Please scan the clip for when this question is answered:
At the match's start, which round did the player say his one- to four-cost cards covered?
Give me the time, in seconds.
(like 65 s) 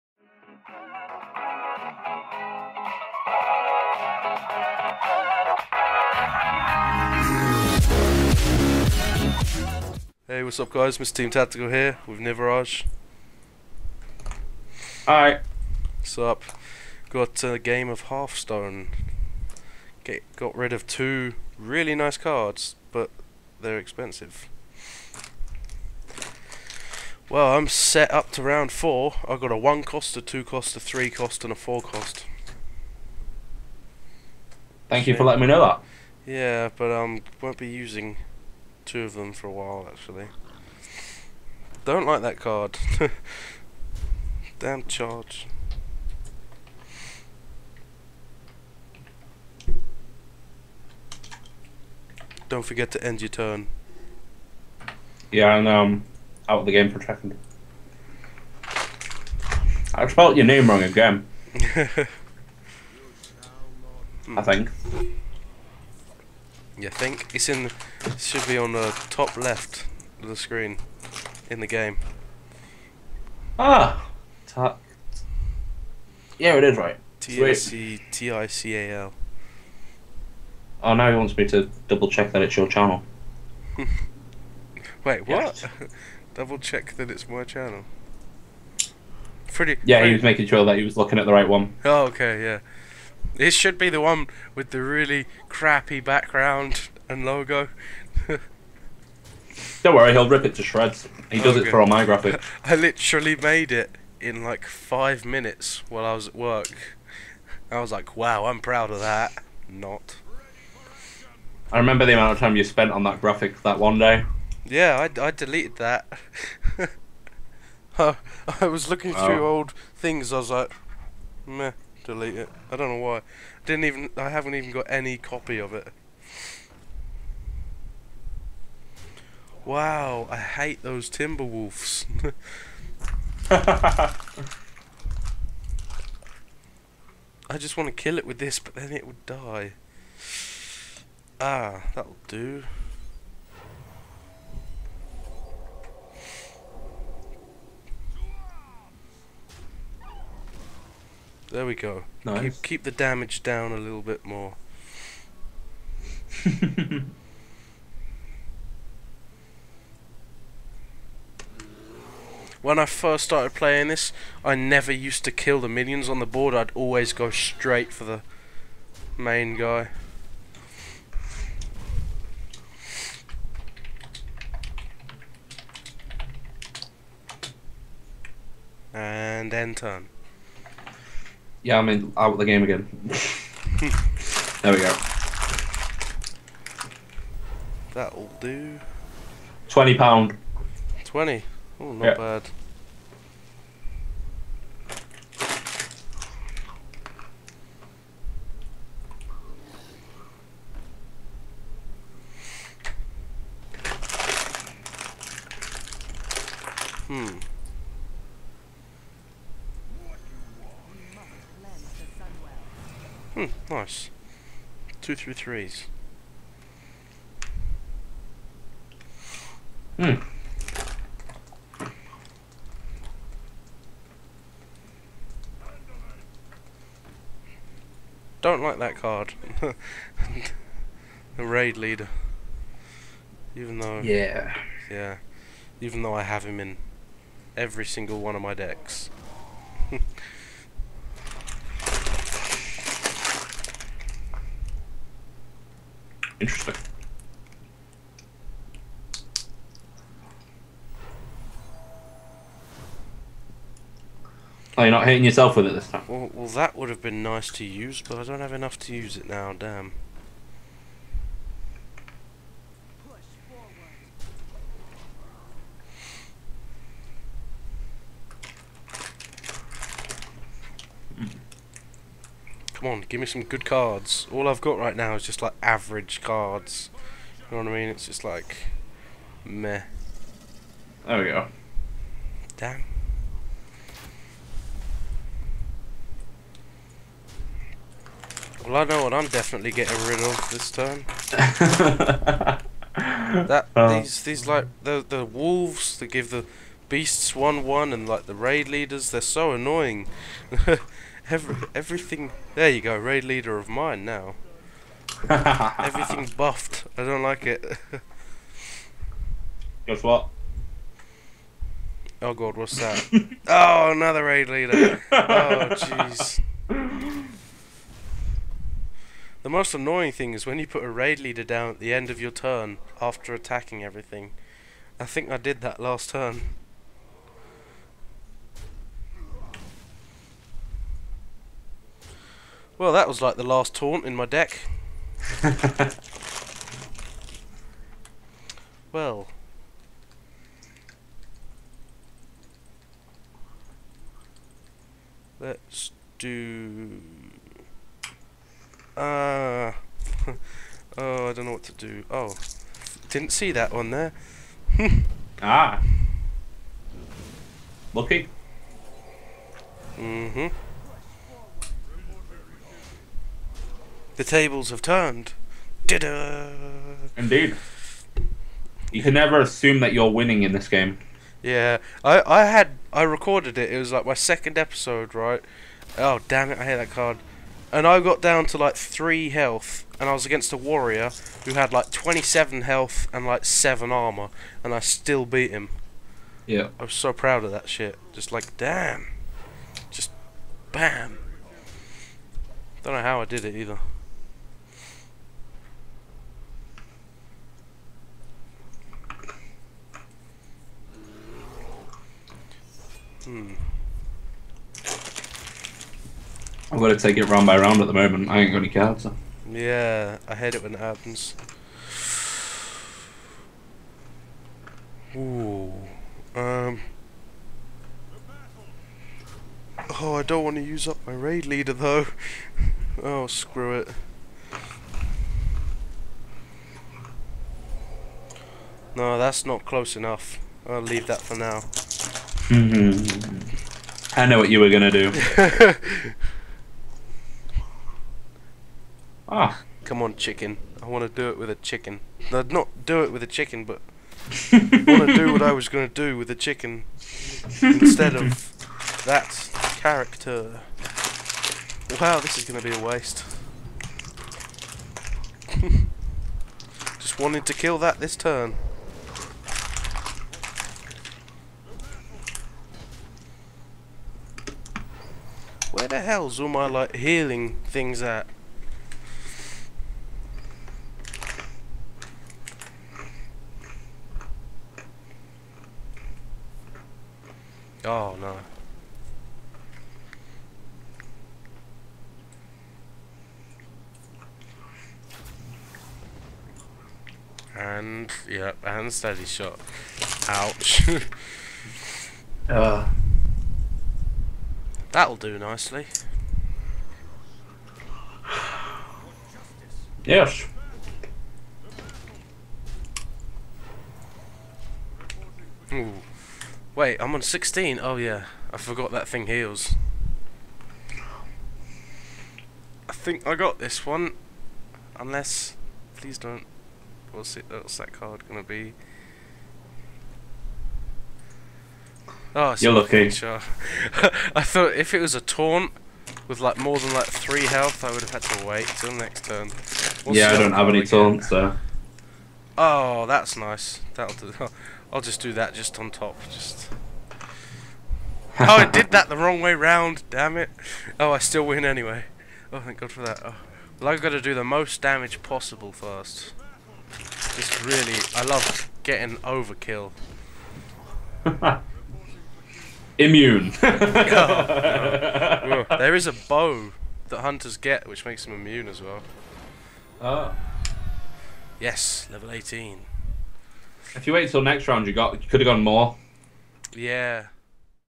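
28 s.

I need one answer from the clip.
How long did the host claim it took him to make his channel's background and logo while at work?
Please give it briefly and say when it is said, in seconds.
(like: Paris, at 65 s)
5 minutes, at 104 s.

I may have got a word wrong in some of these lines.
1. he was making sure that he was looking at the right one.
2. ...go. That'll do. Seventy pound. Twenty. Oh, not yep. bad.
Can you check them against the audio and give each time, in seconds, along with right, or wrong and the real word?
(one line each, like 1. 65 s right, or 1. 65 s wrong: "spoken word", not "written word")
1. 90 s right
2. 184 s wrong: "Twenty", not "Seventy".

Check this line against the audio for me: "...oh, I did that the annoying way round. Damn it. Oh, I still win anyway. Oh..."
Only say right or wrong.
wrong.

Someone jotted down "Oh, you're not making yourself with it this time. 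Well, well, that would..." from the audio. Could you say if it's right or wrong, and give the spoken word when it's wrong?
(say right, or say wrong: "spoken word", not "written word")
wrong: "hitting", not "making".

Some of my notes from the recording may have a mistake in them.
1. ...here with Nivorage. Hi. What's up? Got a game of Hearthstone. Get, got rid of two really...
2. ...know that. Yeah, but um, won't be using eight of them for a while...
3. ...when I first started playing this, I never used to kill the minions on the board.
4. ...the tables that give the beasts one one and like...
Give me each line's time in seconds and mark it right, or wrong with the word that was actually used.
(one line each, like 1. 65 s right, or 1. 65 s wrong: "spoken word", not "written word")
1. 11 s right
2. 35 s wrong: "two", not "eight"
3. 162 s right
4. 295 s wrong: "wolves", not "tables".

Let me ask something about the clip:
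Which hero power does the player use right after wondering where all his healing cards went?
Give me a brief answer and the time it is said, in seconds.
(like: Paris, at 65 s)
steady shot, at 488 s.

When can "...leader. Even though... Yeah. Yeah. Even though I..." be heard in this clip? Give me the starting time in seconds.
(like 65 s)
231 s.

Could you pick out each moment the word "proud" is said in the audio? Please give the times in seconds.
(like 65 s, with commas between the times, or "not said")
108 s, 387 s.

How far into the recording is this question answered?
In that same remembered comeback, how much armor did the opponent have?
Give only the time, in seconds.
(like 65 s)
383 s.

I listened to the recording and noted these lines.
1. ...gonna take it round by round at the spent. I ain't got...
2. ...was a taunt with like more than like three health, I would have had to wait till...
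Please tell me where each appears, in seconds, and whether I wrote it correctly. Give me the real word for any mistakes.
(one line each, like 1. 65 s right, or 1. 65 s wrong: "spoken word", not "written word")
1. 406 s wrong: "moment", not "spent"
2. 524 s right.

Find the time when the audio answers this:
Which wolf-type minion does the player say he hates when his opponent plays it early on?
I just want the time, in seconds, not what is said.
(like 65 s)
131 s.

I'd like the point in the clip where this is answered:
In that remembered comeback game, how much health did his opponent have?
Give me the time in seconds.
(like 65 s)
381 s.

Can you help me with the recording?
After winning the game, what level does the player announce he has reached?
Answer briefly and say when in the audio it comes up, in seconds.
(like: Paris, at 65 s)
level 18, at 562 s.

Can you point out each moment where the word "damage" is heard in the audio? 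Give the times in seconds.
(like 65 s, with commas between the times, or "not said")
152 s, 544 s.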